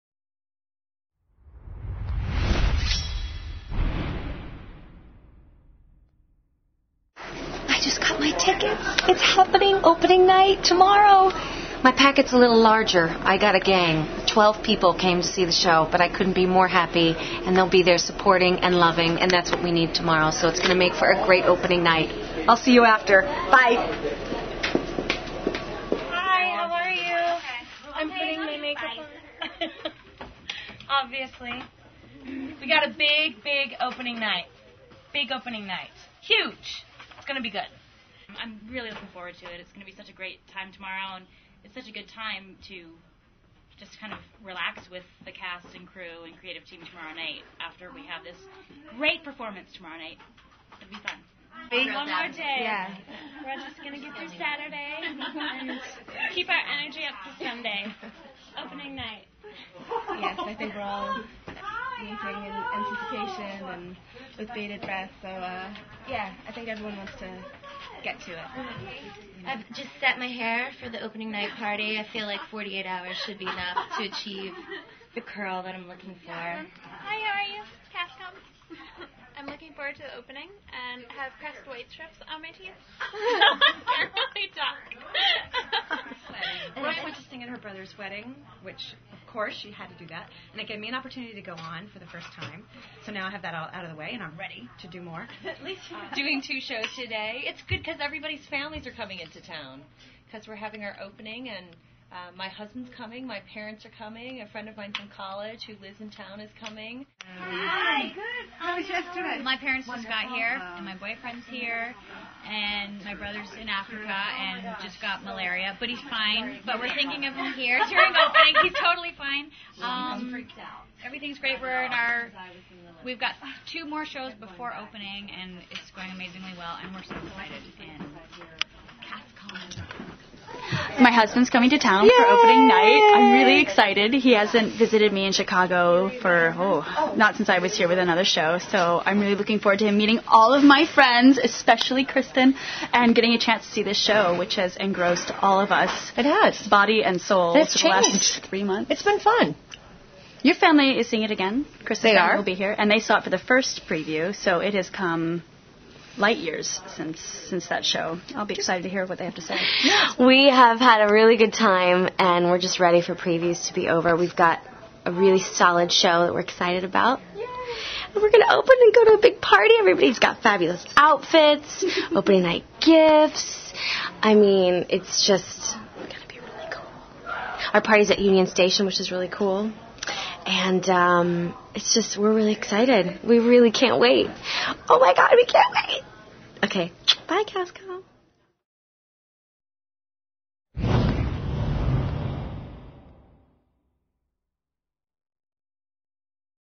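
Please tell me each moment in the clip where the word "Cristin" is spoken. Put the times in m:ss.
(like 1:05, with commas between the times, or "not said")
2:22, 2:31.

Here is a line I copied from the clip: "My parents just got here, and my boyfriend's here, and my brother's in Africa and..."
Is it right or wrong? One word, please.
right.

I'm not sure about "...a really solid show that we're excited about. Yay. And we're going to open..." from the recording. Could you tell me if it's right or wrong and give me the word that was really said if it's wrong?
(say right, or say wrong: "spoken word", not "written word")
right.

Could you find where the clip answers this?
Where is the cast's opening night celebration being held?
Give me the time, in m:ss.
2:58.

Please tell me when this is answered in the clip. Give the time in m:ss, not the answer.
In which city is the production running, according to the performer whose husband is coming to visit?
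2:15.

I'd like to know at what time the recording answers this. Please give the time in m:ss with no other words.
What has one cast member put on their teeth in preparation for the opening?
1:21.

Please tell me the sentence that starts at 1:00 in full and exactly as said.
Yes, I think we're all waiting in anticipation and with bated breath.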